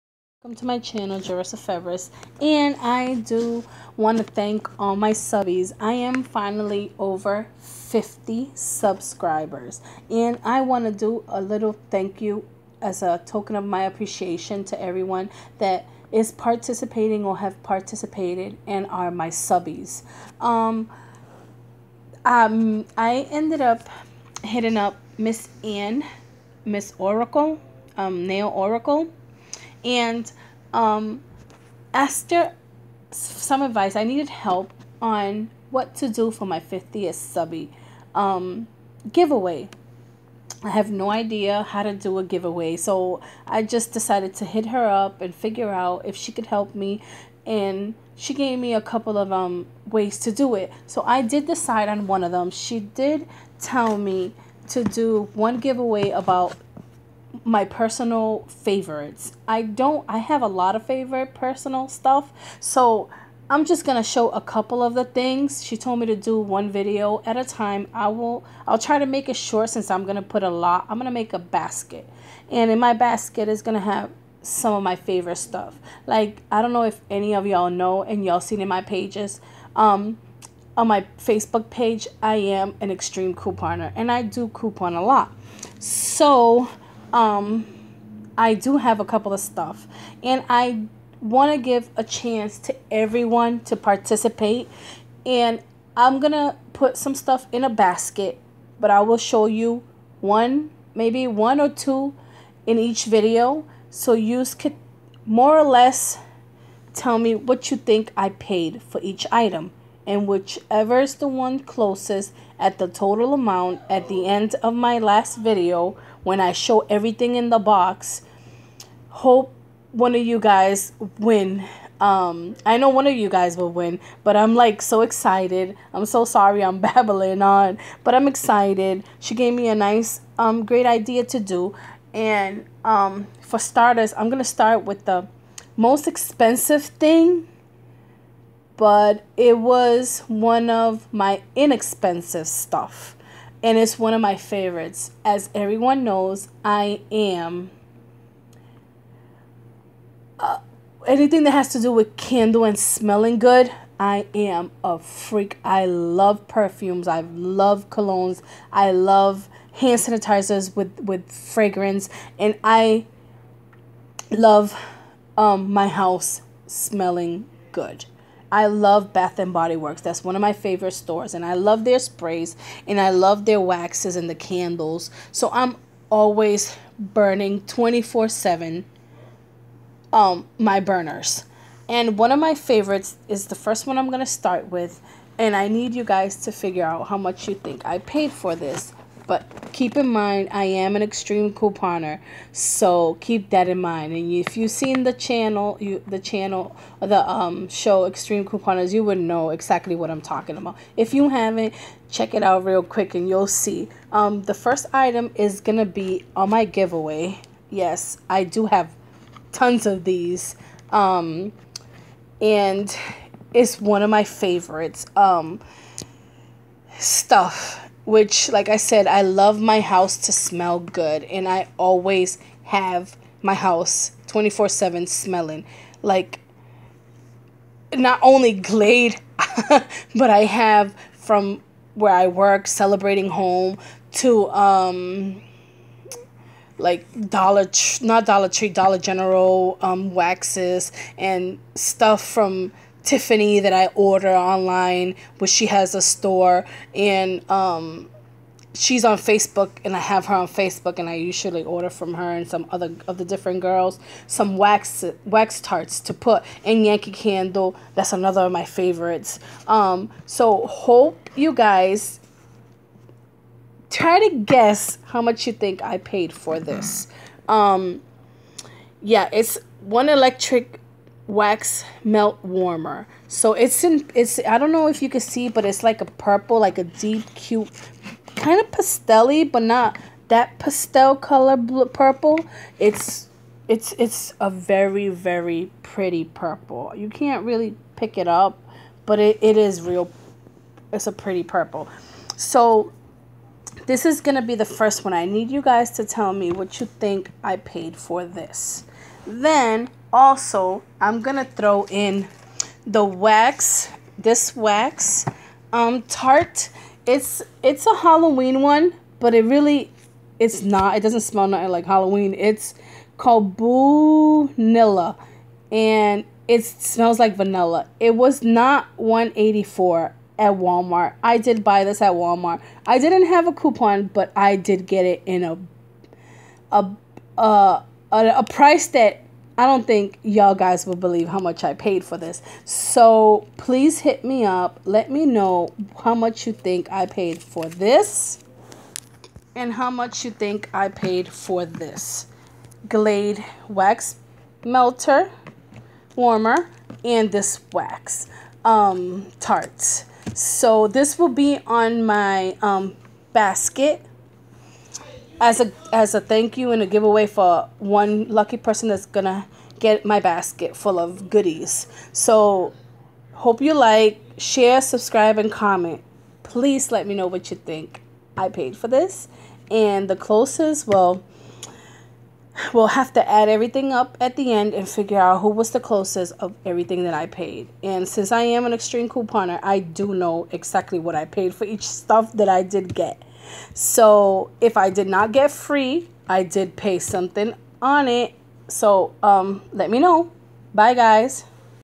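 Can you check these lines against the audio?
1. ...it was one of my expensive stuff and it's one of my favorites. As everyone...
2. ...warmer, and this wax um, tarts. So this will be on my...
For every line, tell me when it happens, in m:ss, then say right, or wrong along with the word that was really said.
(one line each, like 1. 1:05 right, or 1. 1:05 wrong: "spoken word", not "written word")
1. 2:19 wrong: "inexpensive", not "expensive"
2. 5:46 right.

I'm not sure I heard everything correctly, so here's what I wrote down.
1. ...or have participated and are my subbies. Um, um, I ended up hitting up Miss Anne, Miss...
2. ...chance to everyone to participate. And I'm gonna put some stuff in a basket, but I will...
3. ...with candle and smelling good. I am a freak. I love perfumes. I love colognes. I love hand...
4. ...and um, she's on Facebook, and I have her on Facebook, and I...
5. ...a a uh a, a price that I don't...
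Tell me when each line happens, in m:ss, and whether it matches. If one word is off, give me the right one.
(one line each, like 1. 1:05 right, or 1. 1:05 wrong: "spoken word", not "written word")
1. 0:17 right
2. 1:32 right
3. 2:31 right
4. 4:06 right
5. 5:25 right.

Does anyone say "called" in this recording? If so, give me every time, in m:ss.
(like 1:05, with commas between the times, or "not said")
5:13.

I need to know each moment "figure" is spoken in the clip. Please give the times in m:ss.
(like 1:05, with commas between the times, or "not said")
0:45, 3:06, 6:14.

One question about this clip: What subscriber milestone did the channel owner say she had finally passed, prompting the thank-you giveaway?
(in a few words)
50.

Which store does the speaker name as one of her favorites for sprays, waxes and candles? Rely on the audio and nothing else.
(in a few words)
Bath and Body Works.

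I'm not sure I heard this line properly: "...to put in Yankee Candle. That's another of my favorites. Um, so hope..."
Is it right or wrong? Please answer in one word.
right.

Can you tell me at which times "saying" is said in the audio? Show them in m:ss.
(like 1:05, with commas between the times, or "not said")
not said.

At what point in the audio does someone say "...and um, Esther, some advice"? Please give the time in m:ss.
0:29.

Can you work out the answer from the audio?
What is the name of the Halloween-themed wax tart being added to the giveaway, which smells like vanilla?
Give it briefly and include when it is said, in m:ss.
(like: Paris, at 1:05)
Boonilla, at 5:13.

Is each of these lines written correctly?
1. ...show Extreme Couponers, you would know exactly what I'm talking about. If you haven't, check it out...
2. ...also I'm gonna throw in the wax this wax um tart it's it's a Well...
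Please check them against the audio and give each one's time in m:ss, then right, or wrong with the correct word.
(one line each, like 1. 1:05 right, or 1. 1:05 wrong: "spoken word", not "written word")
1. 3:17 right
2. 5:00 wrong: "Halloween", not "Well".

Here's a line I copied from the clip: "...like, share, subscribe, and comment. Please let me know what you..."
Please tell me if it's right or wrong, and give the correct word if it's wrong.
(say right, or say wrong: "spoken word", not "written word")
right.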